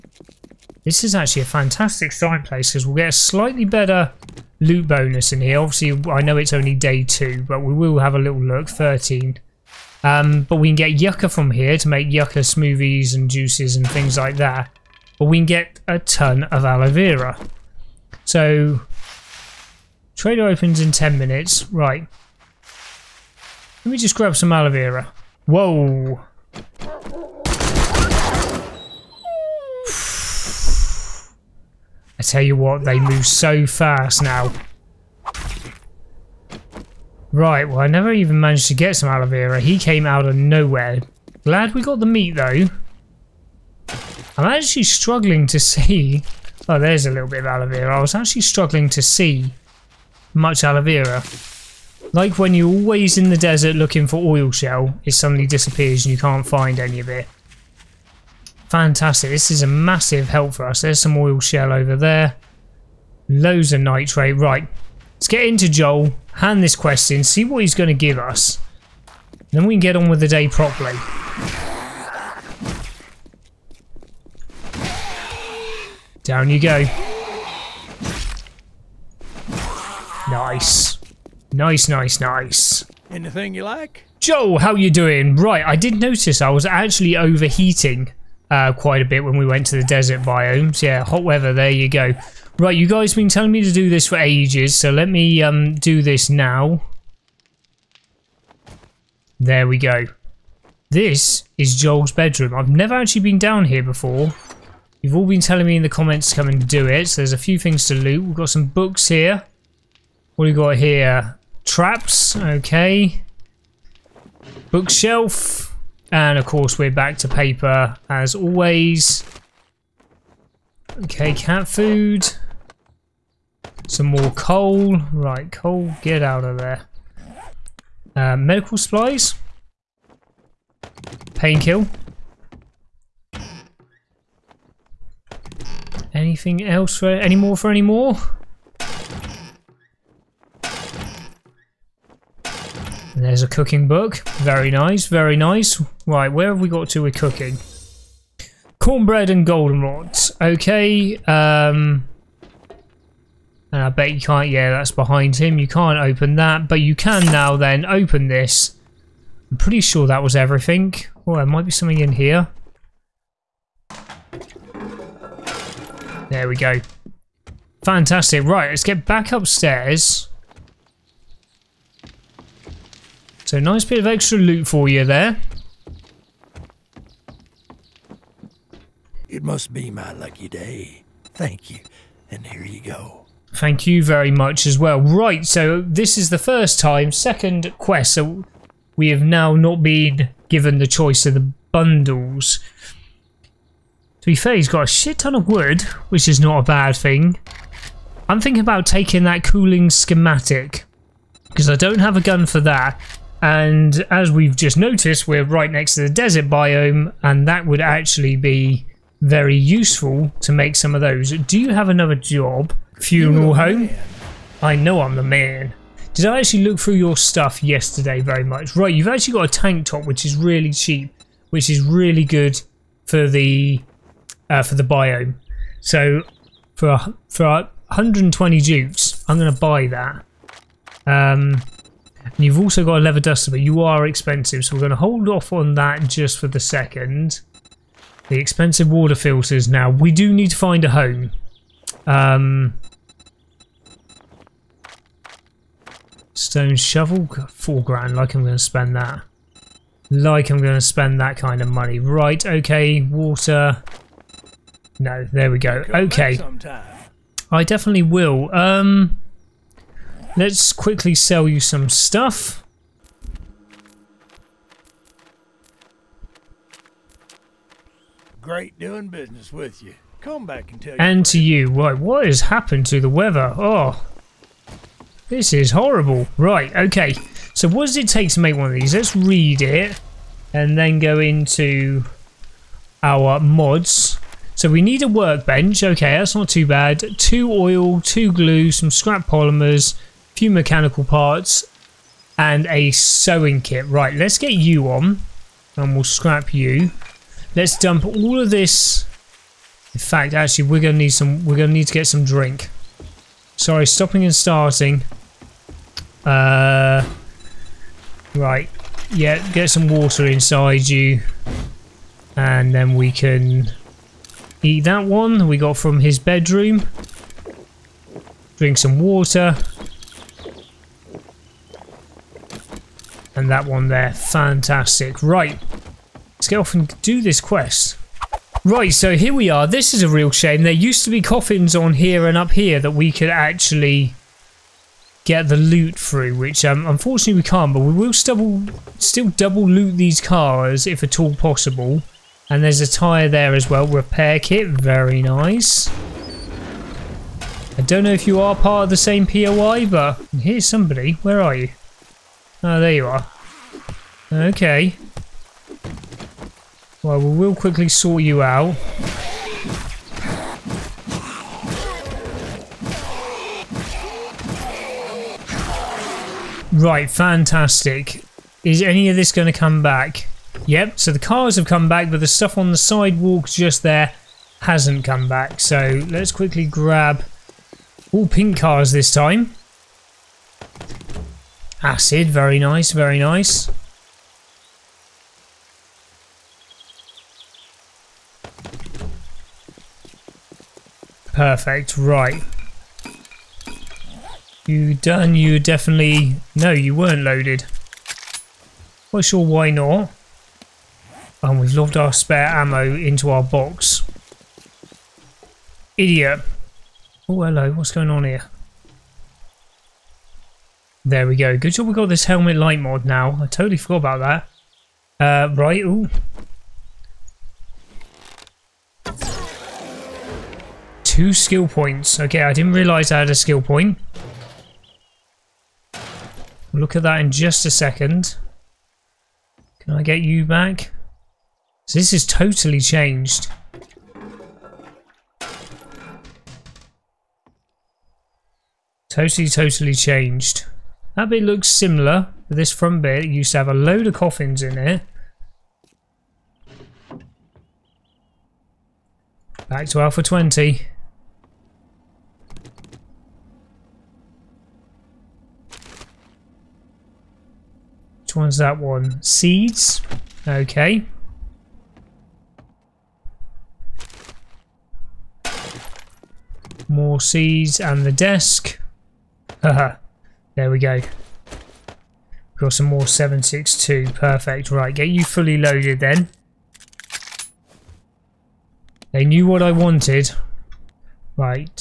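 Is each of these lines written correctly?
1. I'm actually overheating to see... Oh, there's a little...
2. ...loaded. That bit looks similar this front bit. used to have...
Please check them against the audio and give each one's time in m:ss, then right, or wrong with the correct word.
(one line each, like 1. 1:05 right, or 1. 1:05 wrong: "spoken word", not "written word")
1. 0:44 wrong: "struggling", not "overheating"
2. 7:19 wrong: "changed", not "loaded".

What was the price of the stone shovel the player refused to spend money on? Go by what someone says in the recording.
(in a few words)
4000.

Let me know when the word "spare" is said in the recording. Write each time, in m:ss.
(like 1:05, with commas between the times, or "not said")
6:42.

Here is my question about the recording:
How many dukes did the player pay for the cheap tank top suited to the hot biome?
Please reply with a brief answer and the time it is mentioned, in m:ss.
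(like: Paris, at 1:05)
120, at 3:47.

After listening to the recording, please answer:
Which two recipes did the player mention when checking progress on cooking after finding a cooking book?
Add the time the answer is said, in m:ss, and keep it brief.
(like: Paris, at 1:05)
Cornbread and goldenrods, at 2:28.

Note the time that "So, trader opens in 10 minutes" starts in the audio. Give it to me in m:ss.
0:18.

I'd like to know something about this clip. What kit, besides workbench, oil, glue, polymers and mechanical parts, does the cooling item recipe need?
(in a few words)
Sewing kit.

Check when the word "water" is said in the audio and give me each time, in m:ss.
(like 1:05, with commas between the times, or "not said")
3:58, 4:13, 5:09, 5:18.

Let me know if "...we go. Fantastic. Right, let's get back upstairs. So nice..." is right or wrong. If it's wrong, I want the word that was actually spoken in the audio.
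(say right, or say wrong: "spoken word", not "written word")
right.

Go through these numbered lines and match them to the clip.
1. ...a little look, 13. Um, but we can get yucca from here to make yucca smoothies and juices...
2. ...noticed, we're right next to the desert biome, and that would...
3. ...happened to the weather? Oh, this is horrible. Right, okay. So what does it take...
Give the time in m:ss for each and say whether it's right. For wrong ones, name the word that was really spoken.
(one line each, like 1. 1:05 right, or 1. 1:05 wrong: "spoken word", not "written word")
1. 0:08 right
2. 3:24 right
3. 4:32 right.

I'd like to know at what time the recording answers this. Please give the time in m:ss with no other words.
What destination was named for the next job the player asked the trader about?
3:32.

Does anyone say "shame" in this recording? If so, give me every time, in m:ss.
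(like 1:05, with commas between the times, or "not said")
5:30.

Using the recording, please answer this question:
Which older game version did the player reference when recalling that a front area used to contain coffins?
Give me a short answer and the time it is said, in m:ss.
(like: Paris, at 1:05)
Alpha 20, at 7:30.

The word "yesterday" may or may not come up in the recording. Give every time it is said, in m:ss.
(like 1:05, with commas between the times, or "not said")
3:37.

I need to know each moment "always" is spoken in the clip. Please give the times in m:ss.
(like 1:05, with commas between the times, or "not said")
0:52, 1:58.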